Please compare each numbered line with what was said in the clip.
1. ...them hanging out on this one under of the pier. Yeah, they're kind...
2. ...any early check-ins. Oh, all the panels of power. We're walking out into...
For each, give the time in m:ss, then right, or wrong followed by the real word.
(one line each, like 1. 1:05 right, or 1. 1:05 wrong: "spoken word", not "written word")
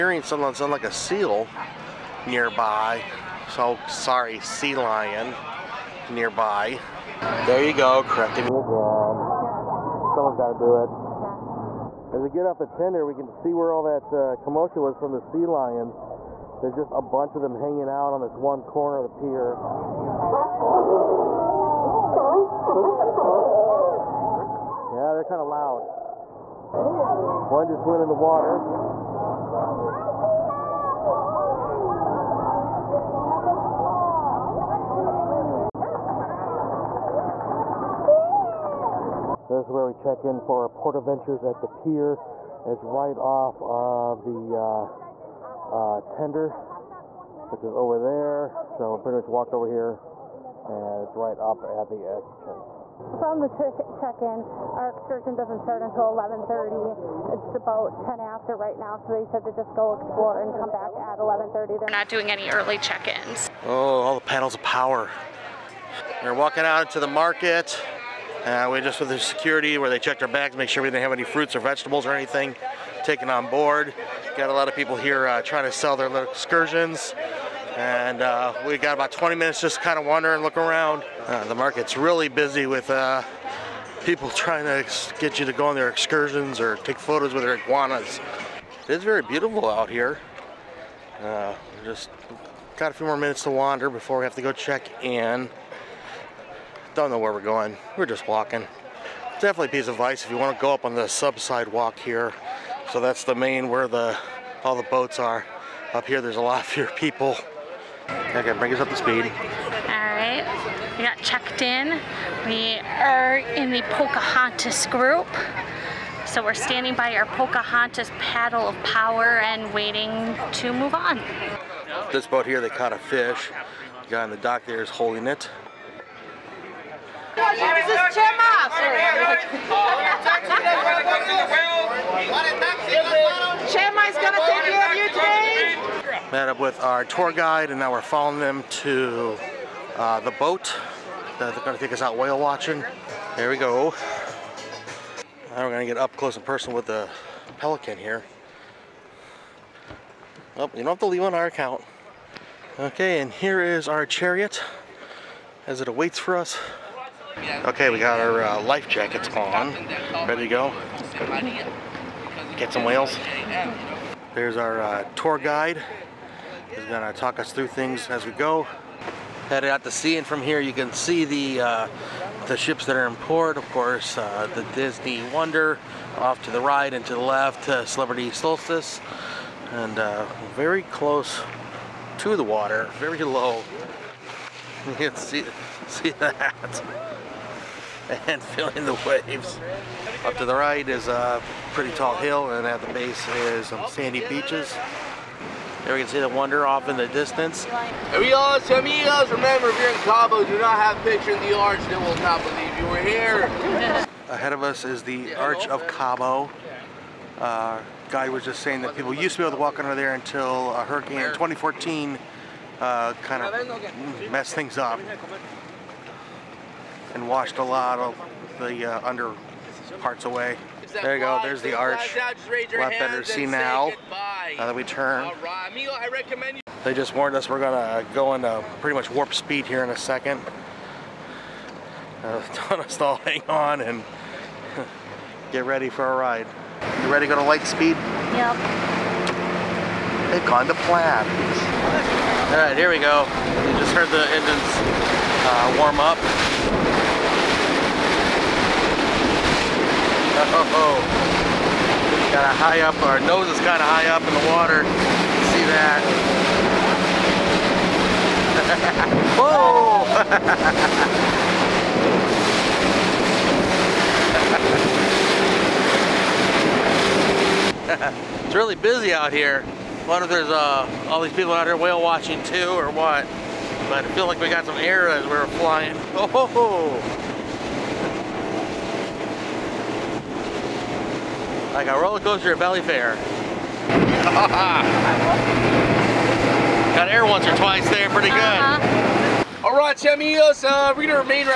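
1. 0:17 wrong: "corner", not "under"
2. 1:02 right.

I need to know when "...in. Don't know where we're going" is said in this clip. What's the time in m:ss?
1:35.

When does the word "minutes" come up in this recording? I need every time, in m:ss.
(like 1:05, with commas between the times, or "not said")
1:19, 1:33.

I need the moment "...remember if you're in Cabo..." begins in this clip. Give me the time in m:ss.
3:19.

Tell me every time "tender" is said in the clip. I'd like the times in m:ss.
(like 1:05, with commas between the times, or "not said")
0:12, 0:46.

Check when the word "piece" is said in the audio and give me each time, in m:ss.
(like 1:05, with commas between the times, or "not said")
1:39.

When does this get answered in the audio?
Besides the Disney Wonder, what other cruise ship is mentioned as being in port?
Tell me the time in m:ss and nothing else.
2:57.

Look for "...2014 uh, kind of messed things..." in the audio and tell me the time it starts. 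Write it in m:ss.
3:31.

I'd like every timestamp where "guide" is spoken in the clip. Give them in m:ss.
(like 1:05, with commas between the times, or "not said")
2:17, 2:45.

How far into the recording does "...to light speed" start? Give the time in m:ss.
3:57.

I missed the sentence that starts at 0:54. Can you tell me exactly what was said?
Our excursion doesn't start until 11:30.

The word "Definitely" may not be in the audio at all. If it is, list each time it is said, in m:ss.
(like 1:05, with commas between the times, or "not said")
1:39.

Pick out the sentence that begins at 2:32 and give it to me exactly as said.
Okay, and here is our chariot as it awaits for us.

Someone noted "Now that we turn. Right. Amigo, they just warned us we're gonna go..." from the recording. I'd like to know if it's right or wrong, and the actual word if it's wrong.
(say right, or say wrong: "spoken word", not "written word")
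right.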